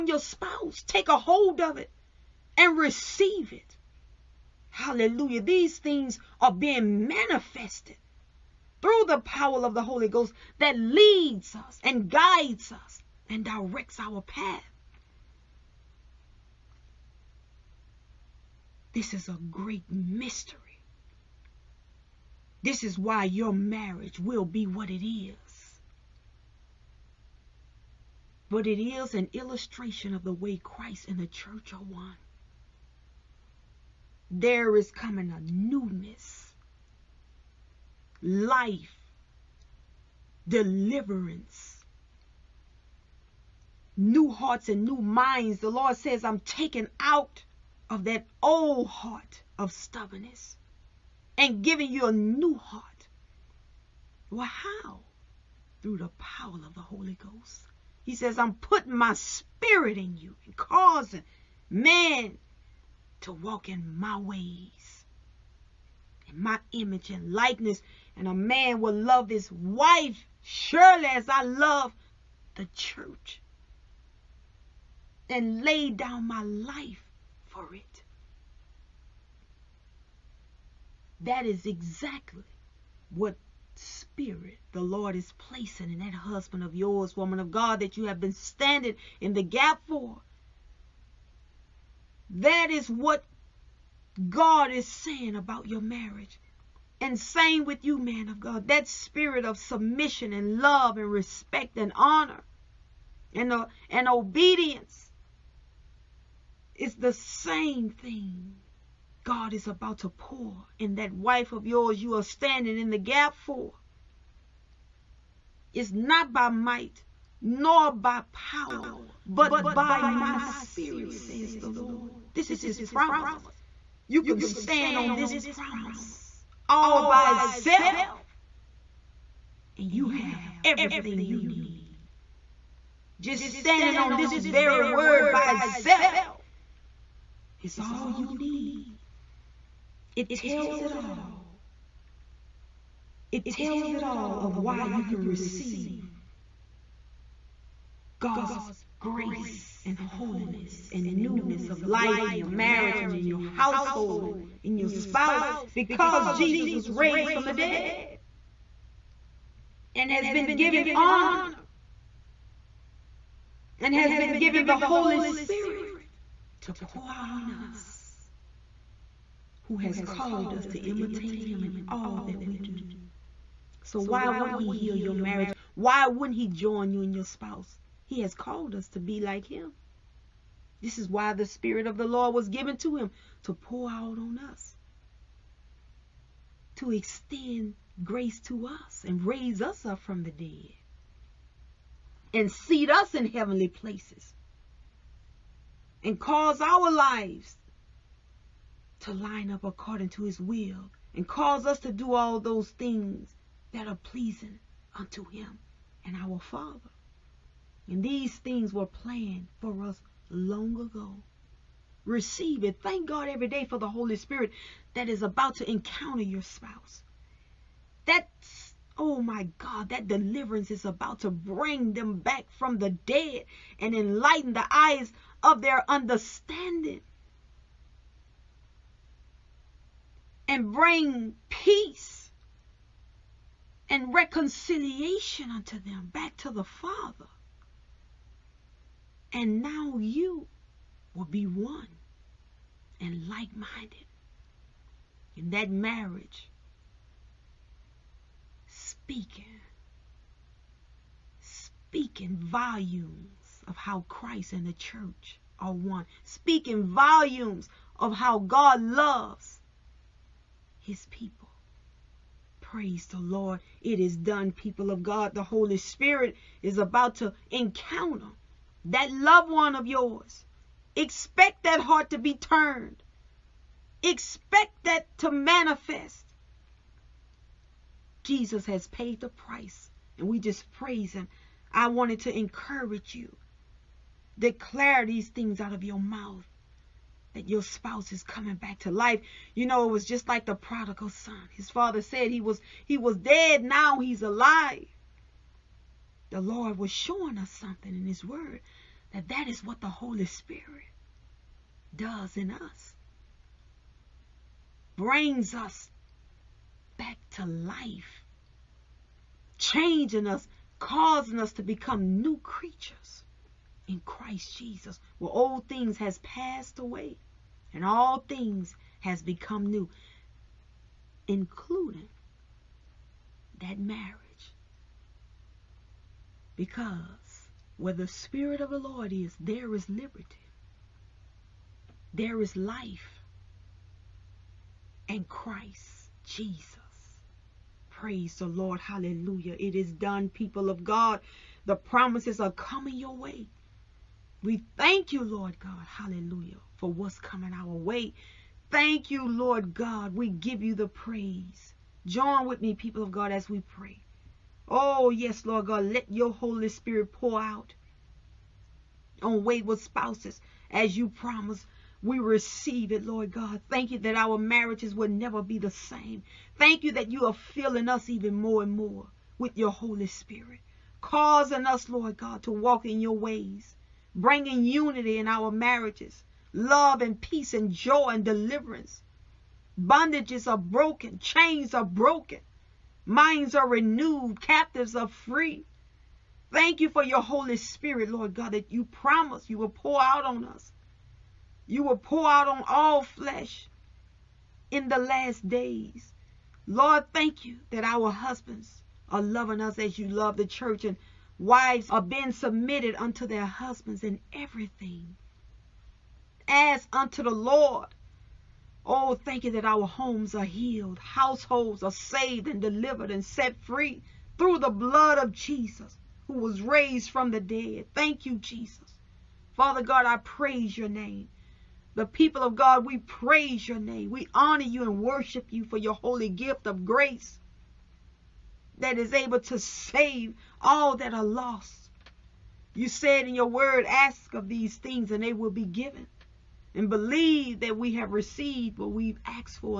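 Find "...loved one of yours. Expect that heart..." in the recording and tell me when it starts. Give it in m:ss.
4:29.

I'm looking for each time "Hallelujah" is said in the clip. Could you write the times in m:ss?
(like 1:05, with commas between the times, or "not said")
0:04, 5:38, 5:45.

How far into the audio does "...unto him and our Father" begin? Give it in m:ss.
3:24.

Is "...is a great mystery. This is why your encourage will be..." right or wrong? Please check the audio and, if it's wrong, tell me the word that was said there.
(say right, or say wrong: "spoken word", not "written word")
wrong: "marriage", not "encourage".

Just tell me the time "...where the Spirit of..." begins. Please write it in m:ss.
5:27.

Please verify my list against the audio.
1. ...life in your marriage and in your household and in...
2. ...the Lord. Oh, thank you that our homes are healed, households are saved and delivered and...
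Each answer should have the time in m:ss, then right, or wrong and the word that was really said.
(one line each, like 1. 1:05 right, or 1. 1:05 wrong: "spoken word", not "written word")
1. 2:31 right
2. 6:47 right.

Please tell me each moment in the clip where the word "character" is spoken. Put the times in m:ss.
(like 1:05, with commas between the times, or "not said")
not said.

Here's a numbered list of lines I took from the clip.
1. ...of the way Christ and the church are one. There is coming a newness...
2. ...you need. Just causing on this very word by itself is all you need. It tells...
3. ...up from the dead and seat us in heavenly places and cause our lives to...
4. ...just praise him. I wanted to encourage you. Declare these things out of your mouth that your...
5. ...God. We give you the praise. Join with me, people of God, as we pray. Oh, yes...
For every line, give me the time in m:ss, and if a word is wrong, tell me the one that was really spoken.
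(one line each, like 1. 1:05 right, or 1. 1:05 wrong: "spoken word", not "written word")
1. 0:30 right
2. 2:11 wrong: "standing", not "causing"
3. 3:09 right
4. 4:40 right
5. 5:49 right.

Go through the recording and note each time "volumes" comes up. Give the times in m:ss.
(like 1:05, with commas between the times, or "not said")
4:12, 4:16.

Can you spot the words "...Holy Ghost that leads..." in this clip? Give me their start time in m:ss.
0:09.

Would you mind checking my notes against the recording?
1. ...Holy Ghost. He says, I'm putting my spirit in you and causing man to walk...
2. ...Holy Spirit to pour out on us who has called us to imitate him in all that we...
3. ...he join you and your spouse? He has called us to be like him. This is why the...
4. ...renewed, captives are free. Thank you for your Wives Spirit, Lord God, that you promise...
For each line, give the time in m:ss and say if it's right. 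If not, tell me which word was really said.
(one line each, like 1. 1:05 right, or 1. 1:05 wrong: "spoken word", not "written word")
1. 0:56 right
2. 2:44 right
3. 2:56 right
4. 6:23 wrong: "Holy", not "Wives".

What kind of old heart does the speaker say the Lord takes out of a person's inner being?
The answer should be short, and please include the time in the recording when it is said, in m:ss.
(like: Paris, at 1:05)
Stubbornness, at 0:49.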